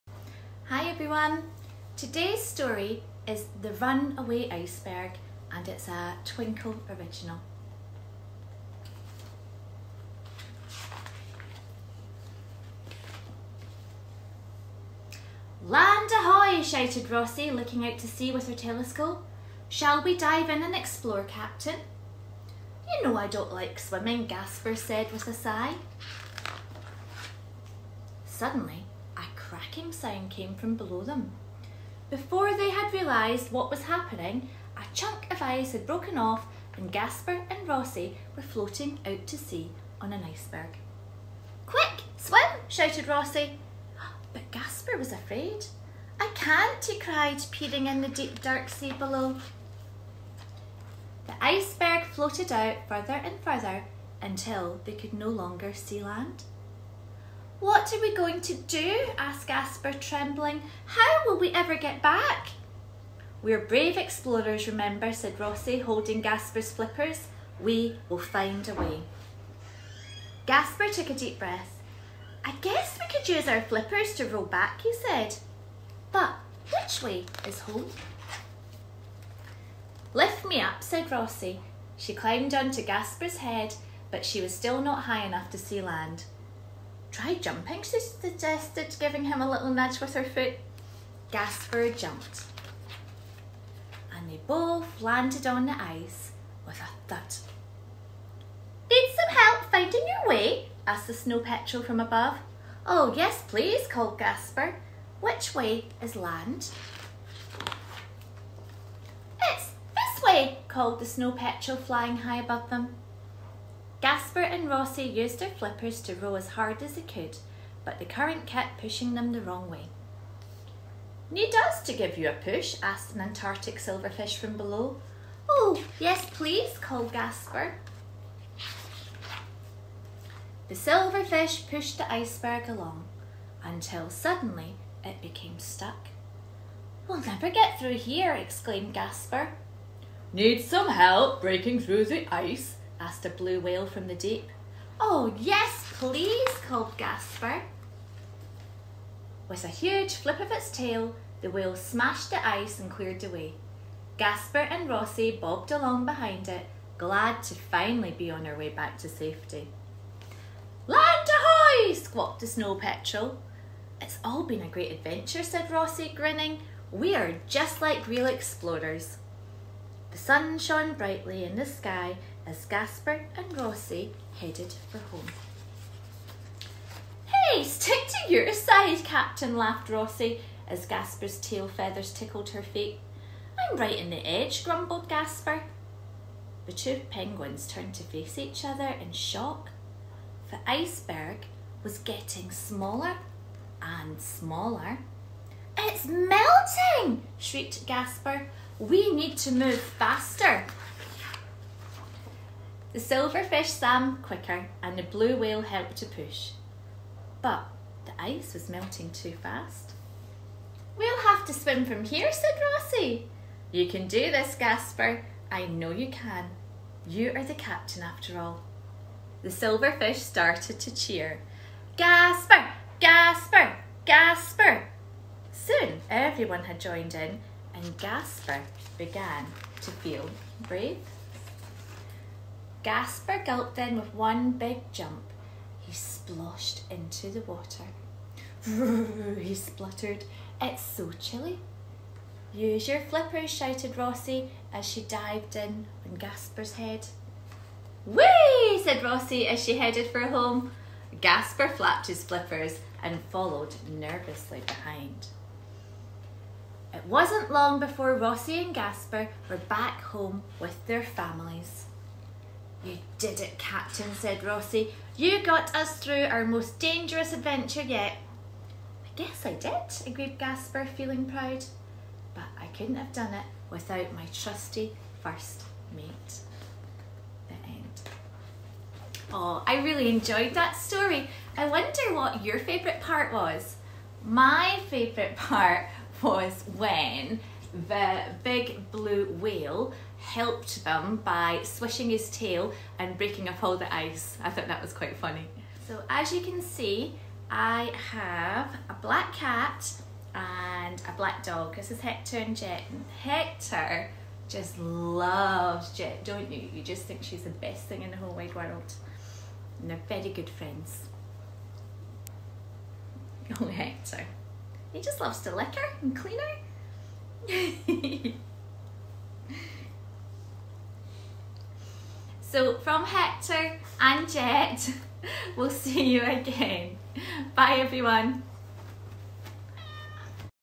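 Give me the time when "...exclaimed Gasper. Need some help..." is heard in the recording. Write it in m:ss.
2:18.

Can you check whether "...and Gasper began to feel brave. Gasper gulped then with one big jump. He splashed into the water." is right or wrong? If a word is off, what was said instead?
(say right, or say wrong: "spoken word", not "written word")
right.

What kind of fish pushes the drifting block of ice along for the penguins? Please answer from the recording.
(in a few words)
Antarctic silverfish.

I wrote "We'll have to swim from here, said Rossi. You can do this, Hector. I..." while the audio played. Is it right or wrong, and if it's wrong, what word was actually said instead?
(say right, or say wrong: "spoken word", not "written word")
wrong: "Gasper", not "Hector".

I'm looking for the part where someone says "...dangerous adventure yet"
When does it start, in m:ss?
4:26.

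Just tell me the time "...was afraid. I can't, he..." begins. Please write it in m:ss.
0:44.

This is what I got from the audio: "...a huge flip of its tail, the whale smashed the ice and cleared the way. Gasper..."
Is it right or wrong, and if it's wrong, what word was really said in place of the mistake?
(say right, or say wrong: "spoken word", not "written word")
right.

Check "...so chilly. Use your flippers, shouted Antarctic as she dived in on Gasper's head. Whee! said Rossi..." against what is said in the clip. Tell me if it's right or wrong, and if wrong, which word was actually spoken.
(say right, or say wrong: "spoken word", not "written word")
wrong: "Rossi", not "Antarctic".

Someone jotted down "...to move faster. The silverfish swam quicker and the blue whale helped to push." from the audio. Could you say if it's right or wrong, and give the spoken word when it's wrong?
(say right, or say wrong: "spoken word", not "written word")
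right.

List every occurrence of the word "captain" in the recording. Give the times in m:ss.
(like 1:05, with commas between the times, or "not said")
0:21, 2:59, 3:37, 4:23.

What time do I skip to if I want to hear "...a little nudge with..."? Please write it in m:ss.
1:29.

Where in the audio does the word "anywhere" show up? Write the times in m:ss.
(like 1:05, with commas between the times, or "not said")
not said.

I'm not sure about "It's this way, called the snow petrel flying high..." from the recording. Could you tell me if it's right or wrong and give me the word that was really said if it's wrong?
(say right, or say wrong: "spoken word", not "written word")
right.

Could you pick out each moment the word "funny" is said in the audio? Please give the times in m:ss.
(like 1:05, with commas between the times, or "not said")
4:55.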